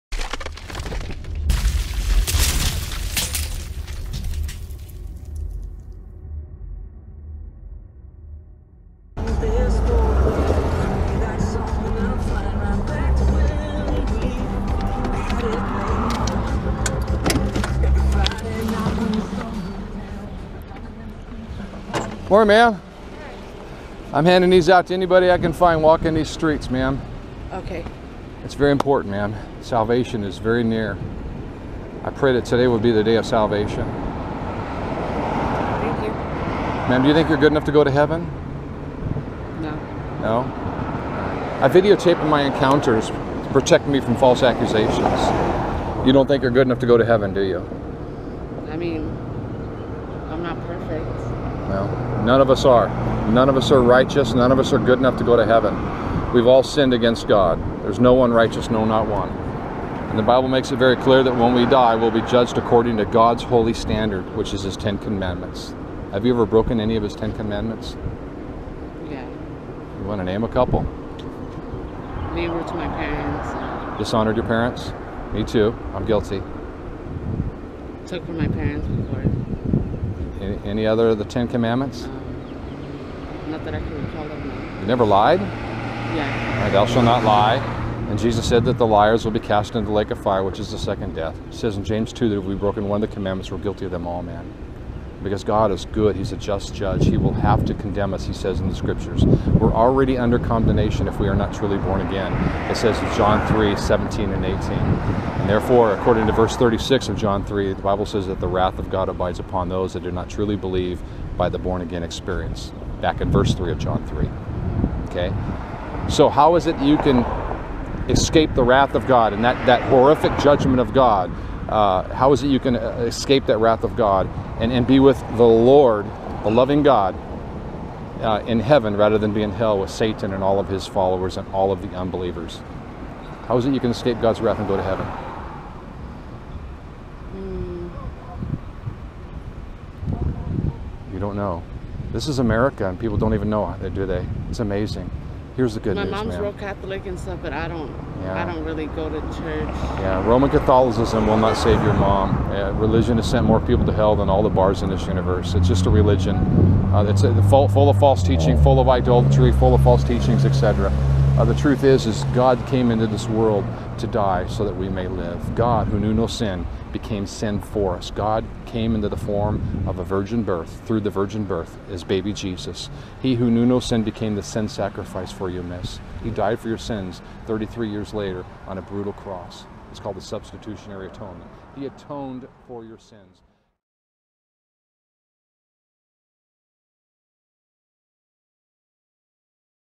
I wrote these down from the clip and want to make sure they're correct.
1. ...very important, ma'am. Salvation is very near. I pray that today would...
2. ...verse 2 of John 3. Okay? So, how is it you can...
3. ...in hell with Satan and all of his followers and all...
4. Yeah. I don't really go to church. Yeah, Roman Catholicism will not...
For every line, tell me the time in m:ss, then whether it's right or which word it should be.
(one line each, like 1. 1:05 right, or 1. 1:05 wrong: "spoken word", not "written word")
1. 0:28 right
2. 1:53 wrong: "3", not "2"
3. 2:09 right
4. 2:28 right.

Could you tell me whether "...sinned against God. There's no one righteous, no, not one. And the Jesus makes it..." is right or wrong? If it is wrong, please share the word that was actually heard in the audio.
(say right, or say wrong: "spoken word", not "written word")
wrong: "Bible", not "Jesus".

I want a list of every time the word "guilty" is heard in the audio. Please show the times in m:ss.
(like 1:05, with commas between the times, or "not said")
1:16, 1:33.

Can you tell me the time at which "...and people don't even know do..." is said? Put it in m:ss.
2:22.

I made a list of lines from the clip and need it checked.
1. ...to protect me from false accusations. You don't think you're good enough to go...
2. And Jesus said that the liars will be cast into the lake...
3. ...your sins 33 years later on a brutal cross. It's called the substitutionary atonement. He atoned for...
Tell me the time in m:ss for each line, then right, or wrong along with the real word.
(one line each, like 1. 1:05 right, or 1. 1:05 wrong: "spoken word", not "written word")
1. 0:43 right
2. 1:28 right
3. 2:56 right.